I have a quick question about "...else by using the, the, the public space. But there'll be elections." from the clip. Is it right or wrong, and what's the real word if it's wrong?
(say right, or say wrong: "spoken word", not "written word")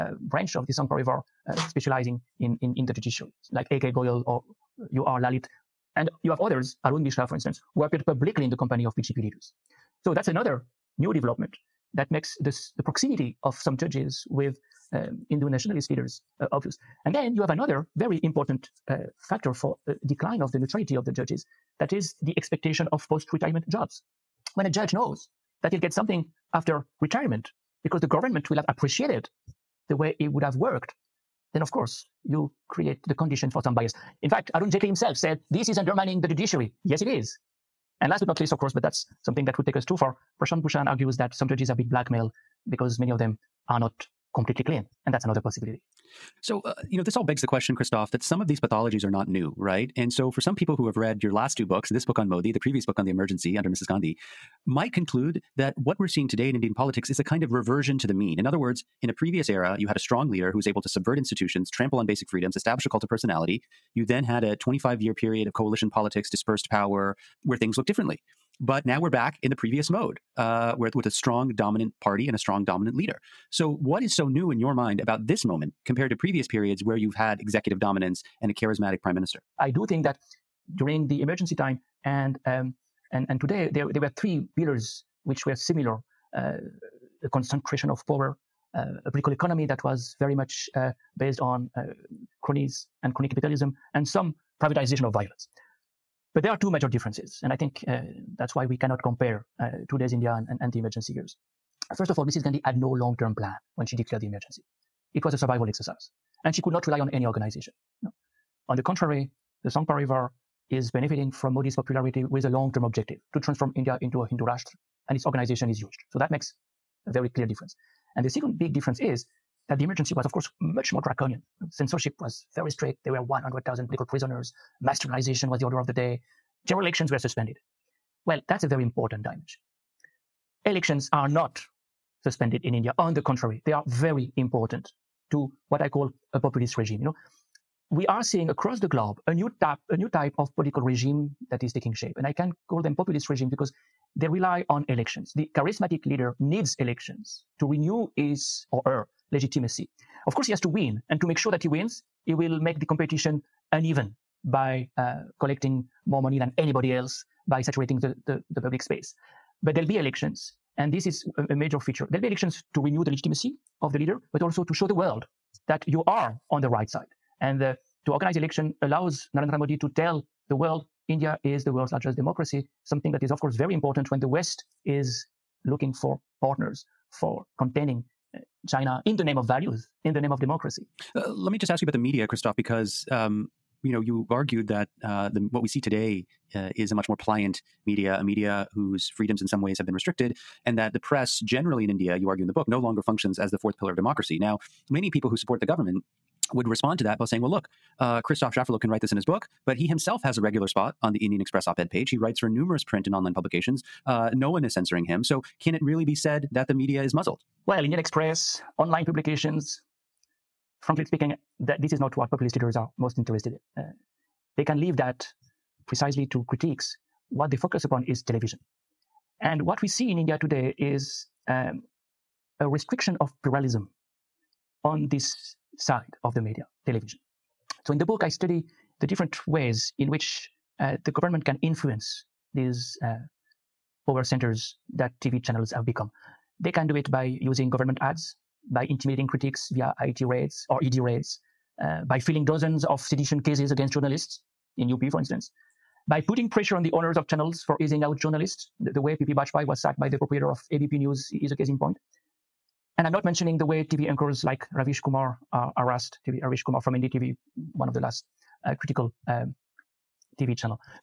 wrong: "saturating", not "using".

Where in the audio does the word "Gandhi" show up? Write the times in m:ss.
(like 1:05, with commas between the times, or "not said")
0:53, 1:42.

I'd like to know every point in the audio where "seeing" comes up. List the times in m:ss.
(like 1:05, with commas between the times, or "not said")
0:56, 2:18.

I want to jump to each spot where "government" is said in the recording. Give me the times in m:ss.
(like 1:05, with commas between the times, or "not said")
0:28, 3:15, 3:51, 3:57.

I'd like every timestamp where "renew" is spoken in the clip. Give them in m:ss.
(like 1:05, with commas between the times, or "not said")
2:27, 2:42.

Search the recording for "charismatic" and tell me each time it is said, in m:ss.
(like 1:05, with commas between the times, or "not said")
1:18, 2:25.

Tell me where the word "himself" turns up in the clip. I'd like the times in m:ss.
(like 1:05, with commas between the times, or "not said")
0:34, 3:19.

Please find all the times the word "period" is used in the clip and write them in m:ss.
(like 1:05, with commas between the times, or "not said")
1:05, 1:16.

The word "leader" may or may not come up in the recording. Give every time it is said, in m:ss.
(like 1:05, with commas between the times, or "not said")
0:09, 0:15, 1:00, 1:12, 2:26, 2:43, 3:32.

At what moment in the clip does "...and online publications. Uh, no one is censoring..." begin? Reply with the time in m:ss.
3:23.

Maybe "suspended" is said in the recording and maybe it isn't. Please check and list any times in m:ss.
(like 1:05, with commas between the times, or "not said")
2:07, 2:12.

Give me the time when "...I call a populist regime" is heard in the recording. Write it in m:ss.
2:15.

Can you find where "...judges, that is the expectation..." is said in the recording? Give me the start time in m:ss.
0:21.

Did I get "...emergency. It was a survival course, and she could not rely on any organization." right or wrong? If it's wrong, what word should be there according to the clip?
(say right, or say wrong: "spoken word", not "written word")
wrong: "exercise", not "course".